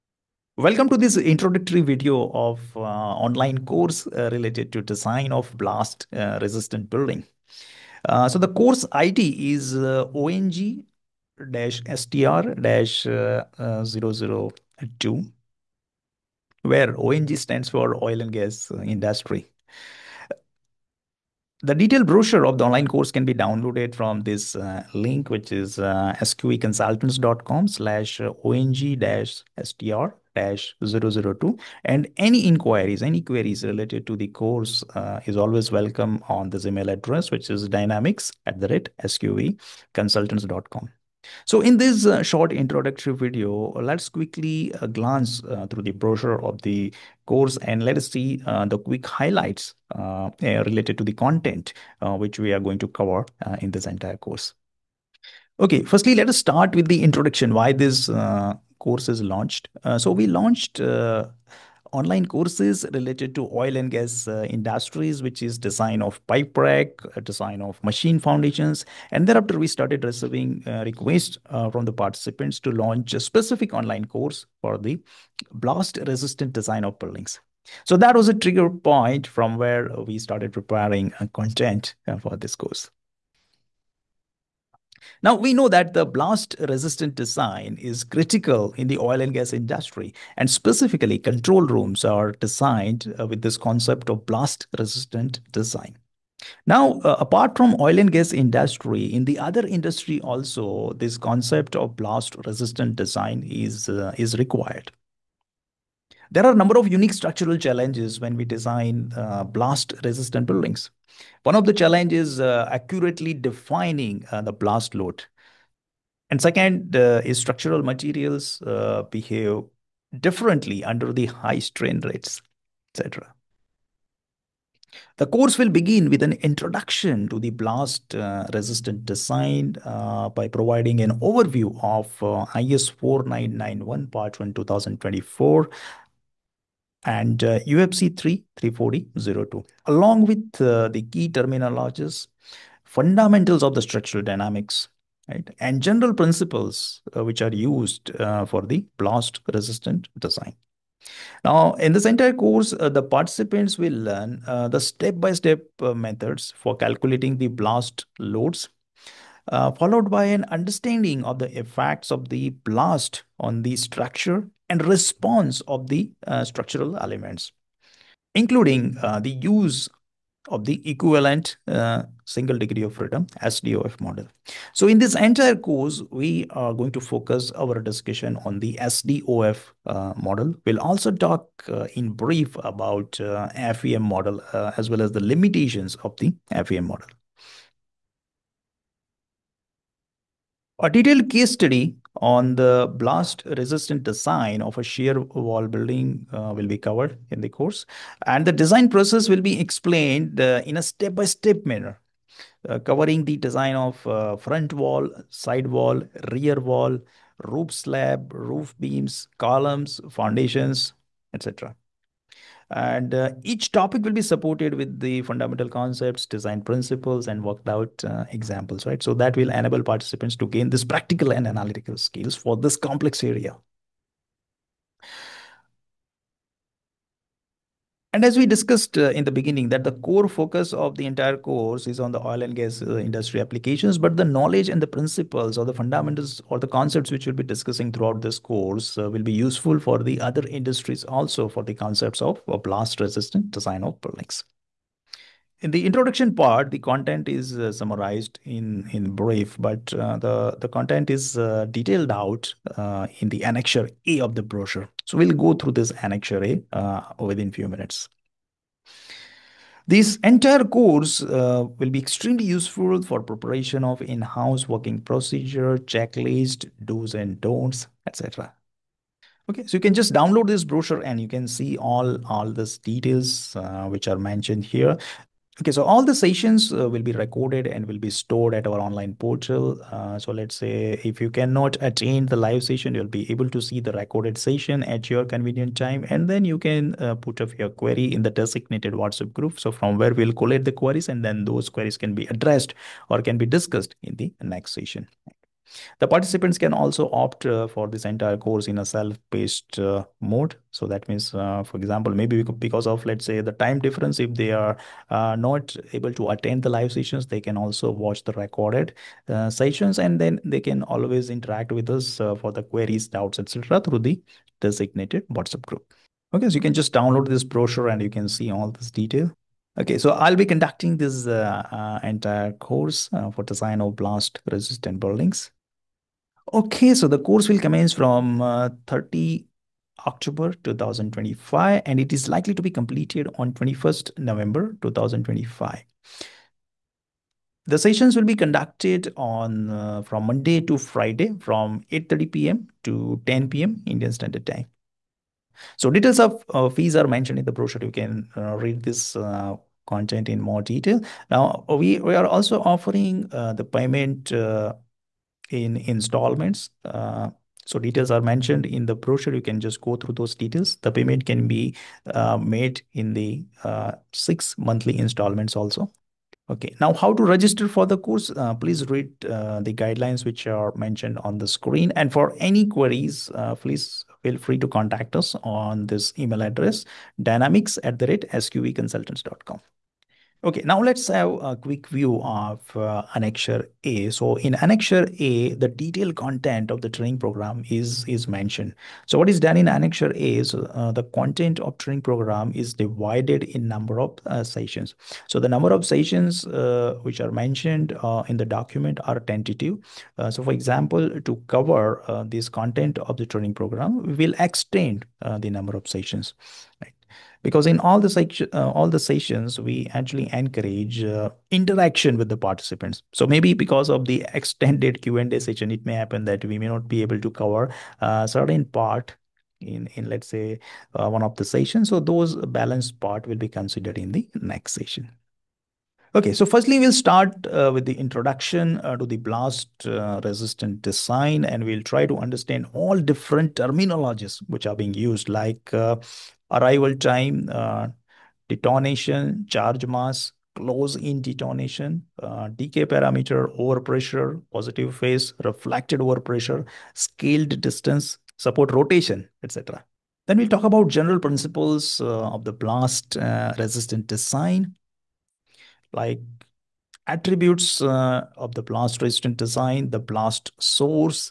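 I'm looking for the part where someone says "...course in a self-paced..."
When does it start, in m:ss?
4:58.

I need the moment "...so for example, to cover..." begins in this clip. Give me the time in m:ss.
6:40.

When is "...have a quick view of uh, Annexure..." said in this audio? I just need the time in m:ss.
6:21.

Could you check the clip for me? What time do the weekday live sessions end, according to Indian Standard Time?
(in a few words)
10 p.m.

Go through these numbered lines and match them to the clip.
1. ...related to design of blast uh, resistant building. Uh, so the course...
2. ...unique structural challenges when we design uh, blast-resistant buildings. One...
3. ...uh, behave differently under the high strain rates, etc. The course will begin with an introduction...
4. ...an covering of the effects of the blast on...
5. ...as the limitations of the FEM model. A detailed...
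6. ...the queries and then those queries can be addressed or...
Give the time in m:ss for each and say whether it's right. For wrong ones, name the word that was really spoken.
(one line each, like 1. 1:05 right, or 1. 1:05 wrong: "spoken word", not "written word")
1. 0:04 right
2. 1:46 right
3. 1:58 right
4. 2:40 wrong: "understanding", not "covering"
5. 3:05 right
6. 4:50 right.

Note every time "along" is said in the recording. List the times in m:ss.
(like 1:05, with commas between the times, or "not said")
2:19.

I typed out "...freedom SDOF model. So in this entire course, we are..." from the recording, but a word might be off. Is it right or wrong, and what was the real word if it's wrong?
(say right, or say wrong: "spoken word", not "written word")
right.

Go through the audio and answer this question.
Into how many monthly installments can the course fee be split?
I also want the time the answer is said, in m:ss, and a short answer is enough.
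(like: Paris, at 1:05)
6, at 6:04.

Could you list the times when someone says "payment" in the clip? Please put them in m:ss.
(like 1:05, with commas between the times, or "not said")
5:53, 6:00.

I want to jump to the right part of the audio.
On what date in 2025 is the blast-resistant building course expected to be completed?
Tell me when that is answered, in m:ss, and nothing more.
5:33.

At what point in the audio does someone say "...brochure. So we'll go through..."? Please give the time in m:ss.
4:14.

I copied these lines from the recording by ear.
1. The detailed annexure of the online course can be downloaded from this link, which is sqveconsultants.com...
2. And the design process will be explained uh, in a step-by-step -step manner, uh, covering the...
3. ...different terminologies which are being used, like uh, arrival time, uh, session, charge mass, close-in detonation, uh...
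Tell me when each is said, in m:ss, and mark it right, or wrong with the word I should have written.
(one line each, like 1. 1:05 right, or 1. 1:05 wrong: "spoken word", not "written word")
1. 0:21 wrong: "brochure", not "annexure"
2. 3:18 right
3. 7:12 wrong: "detonation", not "session".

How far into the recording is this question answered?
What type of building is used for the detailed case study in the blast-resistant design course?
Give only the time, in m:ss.
3:14.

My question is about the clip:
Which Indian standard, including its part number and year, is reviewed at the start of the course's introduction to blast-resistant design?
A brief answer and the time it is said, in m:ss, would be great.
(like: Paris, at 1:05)
IS 4991 Part 1 2024, at 2:12.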